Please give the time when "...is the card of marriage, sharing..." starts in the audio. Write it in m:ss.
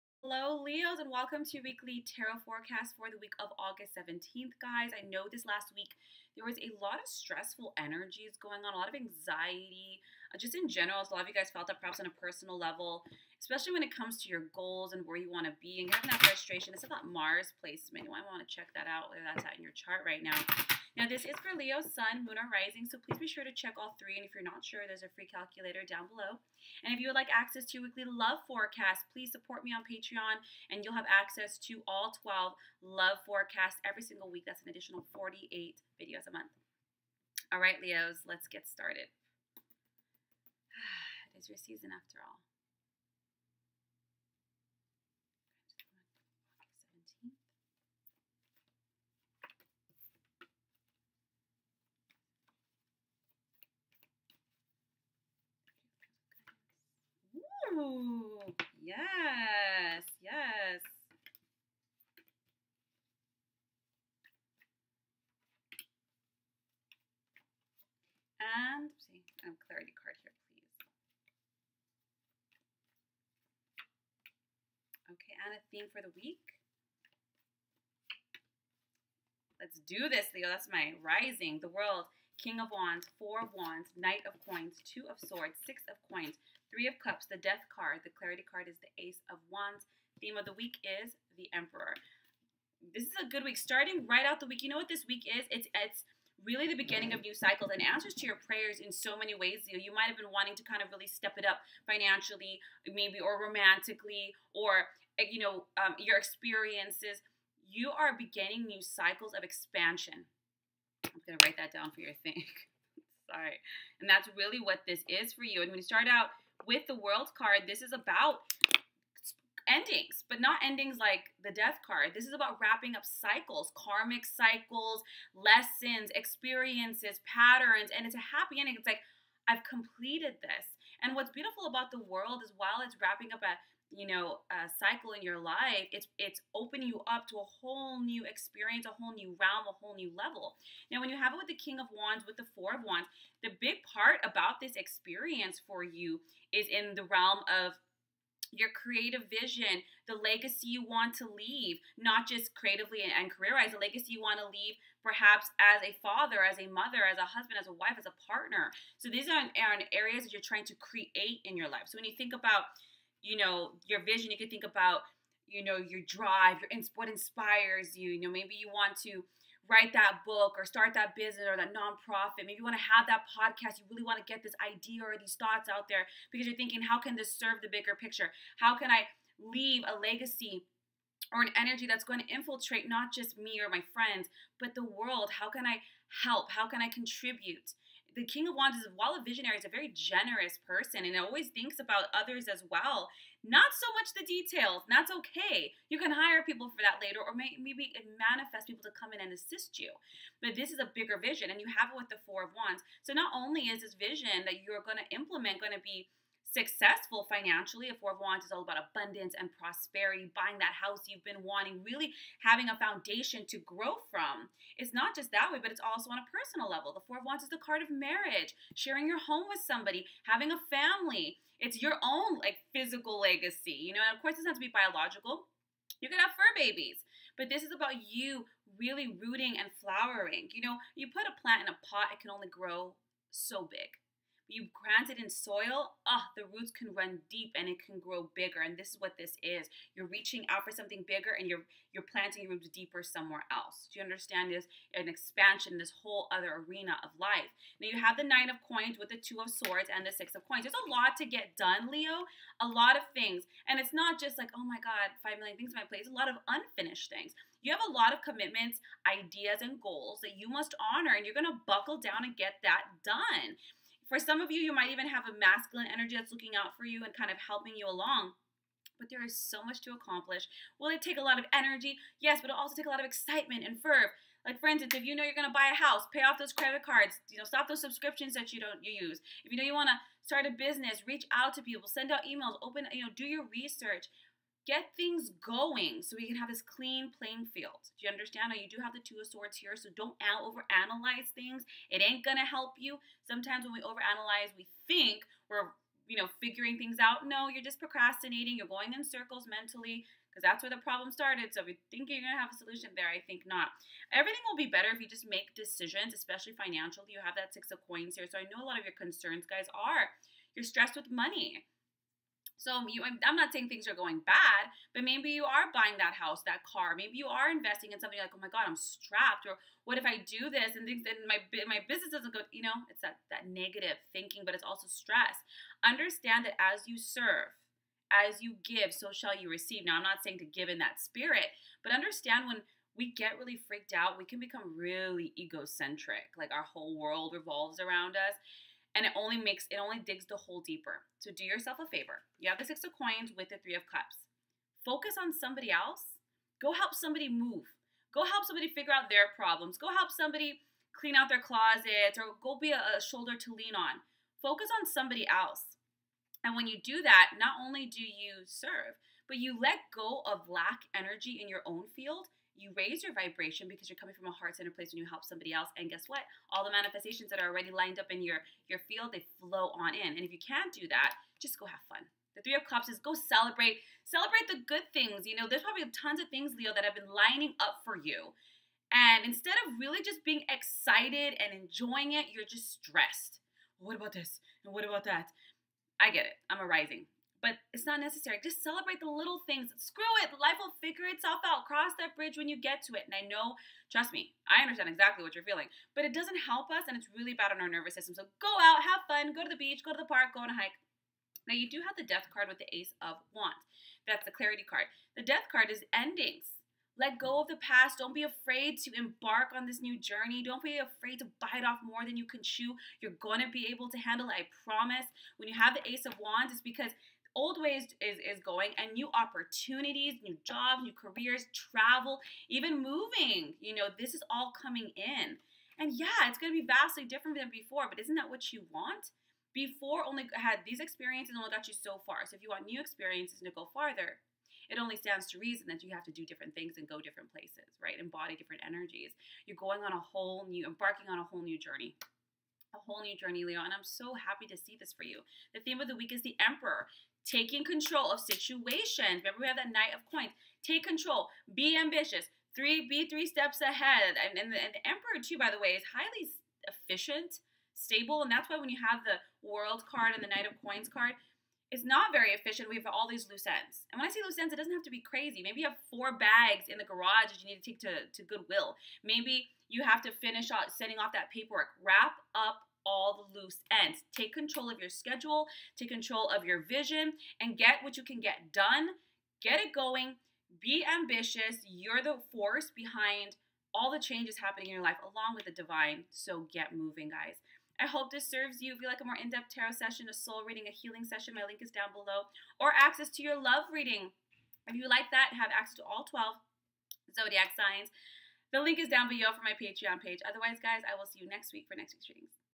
3:37.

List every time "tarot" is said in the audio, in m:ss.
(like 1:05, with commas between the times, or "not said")
0:02, 8:09.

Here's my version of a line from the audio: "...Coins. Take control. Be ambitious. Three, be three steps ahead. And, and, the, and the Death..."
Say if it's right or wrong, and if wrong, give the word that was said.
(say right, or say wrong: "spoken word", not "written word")
wrong: "Emperor", not "Death".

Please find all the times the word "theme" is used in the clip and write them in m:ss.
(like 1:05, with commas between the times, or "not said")
1:15, 1:30, 7:25.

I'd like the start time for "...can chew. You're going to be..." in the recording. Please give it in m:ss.
6:52.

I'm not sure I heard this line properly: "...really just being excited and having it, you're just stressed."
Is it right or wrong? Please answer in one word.
wrong.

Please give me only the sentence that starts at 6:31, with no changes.
Cross that bridge when you get to it.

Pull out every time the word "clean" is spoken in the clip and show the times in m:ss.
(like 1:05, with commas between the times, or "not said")
4:46, 5:50.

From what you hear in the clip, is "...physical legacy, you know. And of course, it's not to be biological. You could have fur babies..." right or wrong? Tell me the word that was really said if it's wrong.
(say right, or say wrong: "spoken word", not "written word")
right.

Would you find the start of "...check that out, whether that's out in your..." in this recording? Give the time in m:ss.
0:18.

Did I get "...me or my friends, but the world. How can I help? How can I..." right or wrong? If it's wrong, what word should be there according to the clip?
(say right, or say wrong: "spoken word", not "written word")
right.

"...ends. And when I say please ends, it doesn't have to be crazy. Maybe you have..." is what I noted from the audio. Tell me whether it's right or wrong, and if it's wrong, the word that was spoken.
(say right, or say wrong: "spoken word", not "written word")
wrong: "loose", not "please".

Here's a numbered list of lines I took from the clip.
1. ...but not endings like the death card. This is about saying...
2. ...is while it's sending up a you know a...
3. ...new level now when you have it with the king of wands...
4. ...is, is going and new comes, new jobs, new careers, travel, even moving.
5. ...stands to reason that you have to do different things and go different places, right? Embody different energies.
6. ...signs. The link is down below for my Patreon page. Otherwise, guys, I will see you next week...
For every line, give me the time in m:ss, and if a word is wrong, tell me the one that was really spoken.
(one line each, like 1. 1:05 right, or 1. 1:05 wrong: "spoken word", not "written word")
1. 2:00 wrong: "wrapping", not "saying"
2. 2:12 wrong: "wrapping", not "sending"
3. 2:19 right
4. 6:58 wrong: "opportunities", not "comes"
5. 7:14 right
6. 8:17 right.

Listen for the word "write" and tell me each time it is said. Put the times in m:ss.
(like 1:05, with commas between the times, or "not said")
1:51, 2:49.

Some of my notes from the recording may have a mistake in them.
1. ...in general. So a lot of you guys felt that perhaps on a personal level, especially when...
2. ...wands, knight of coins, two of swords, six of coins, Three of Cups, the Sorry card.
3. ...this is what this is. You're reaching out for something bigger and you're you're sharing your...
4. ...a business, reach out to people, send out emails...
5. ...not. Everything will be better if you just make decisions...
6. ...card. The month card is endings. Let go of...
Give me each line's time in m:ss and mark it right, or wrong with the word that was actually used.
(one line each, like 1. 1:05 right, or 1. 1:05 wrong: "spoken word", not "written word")
1. 0:10 right
2. 1:23 wrong: "Death", not "Sorry"
3. 3:58 wrong: "planting", not "sharing"
4. 4:40 right
5. 5:03 right
6. 6:44 wrong: "death", not "month".